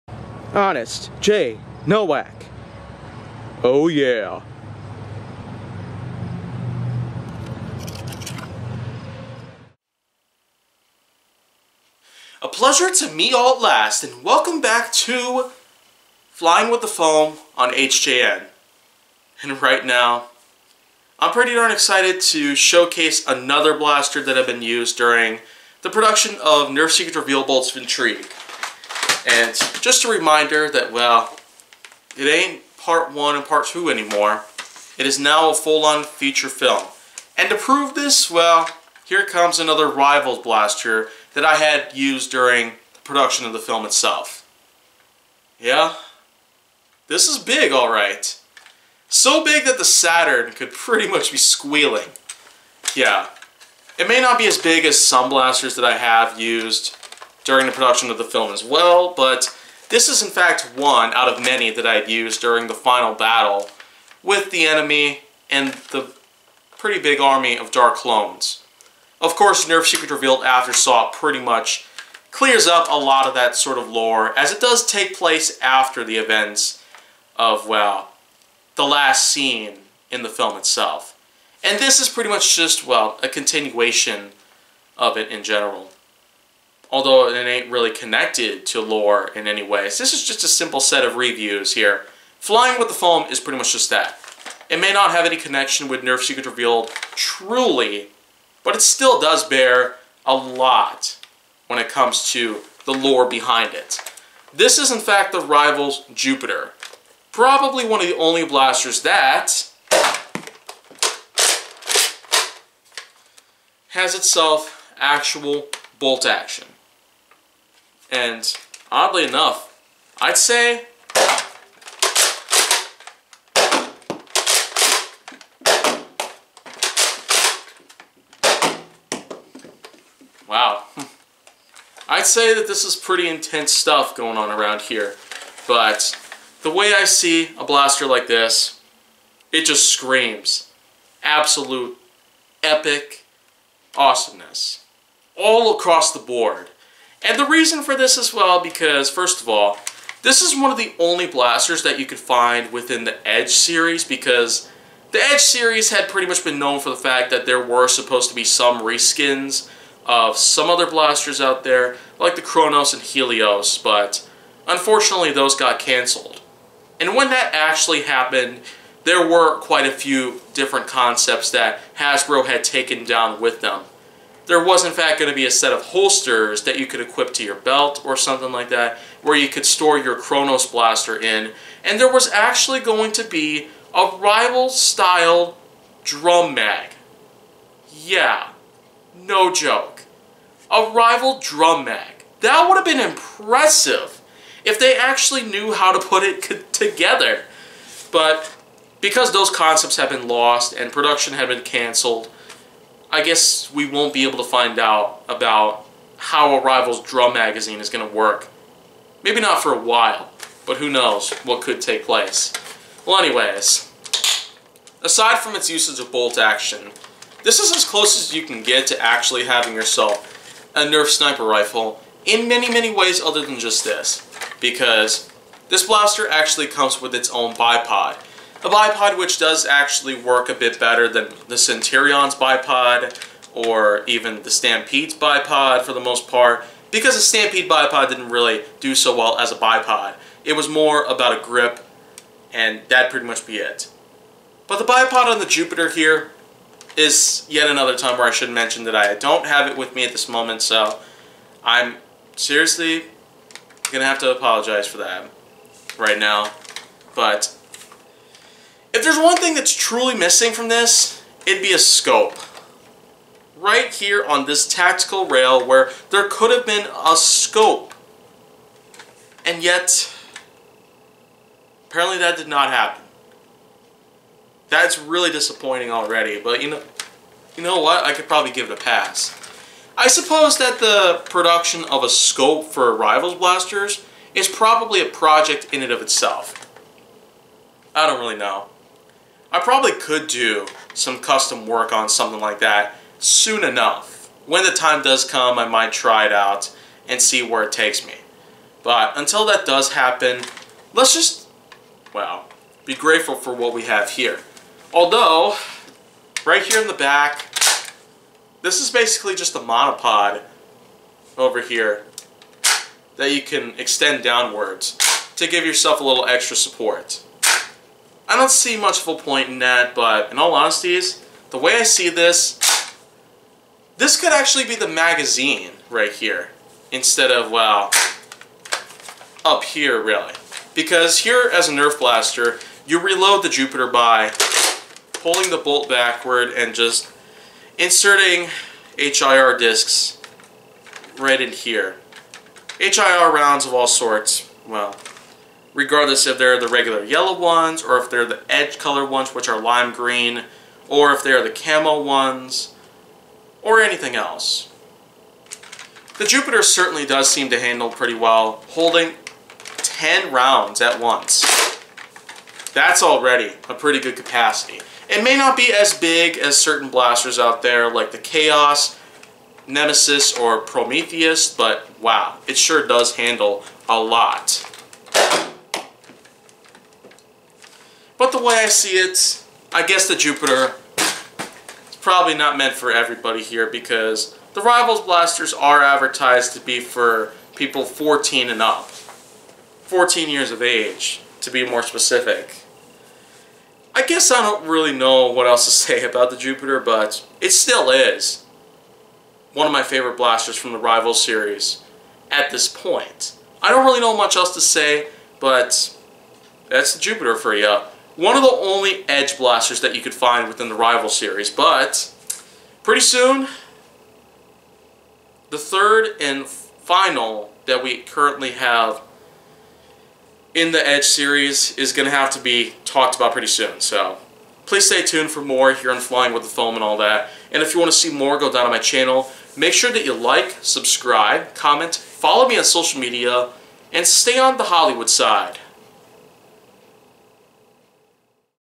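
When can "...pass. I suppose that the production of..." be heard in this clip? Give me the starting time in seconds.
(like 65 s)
278 s.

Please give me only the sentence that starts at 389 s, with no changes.
14 years of age, to be more specific.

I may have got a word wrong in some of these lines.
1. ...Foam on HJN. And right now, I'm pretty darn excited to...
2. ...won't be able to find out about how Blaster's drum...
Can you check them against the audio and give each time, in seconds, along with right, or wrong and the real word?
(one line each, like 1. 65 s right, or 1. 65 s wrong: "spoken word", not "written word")
1. 16 s right
2. 203 s wrong: "Arrival", not "Blaster".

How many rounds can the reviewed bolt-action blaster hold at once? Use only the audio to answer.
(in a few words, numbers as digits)
10.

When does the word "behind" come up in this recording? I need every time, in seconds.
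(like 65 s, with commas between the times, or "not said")
103 s.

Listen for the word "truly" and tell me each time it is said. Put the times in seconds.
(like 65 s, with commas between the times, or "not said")
97 s, 259 s.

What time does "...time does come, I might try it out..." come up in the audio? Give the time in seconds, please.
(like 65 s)
294 s.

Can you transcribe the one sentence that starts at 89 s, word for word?
So this is just a simple set of reviews here.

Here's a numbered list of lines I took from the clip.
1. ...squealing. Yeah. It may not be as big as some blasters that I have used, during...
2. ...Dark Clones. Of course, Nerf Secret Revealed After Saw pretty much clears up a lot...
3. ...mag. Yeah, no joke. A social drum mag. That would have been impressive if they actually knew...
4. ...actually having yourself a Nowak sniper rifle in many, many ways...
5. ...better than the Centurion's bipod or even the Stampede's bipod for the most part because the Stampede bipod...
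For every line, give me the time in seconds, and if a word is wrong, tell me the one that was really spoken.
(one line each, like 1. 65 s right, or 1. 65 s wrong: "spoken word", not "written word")
1. 51 s right
2. 67 s right
3. 186 s wrong: "rival", not "social"
4. 219 s wrong: "Nerf", not "Nowak"
5. 230 s right.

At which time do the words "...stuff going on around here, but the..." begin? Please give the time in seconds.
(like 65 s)
133 s.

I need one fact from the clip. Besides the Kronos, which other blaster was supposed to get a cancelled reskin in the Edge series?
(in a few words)
Helios.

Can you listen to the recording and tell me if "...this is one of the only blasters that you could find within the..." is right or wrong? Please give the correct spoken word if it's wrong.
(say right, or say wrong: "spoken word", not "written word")
right.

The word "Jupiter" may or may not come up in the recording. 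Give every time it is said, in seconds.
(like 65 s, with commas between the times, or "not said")
106 s, 245 s, 333 s, 356 s, 380 s, 396 s, 406 s.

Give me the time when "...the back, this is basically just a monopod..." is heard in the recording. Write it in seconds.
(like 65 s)
306 s.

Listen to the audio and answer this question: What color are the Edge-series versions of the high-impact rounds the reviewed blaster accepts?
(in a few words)
lime green.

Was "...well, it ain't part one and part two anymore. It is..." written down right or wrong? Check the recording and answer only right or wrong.
right.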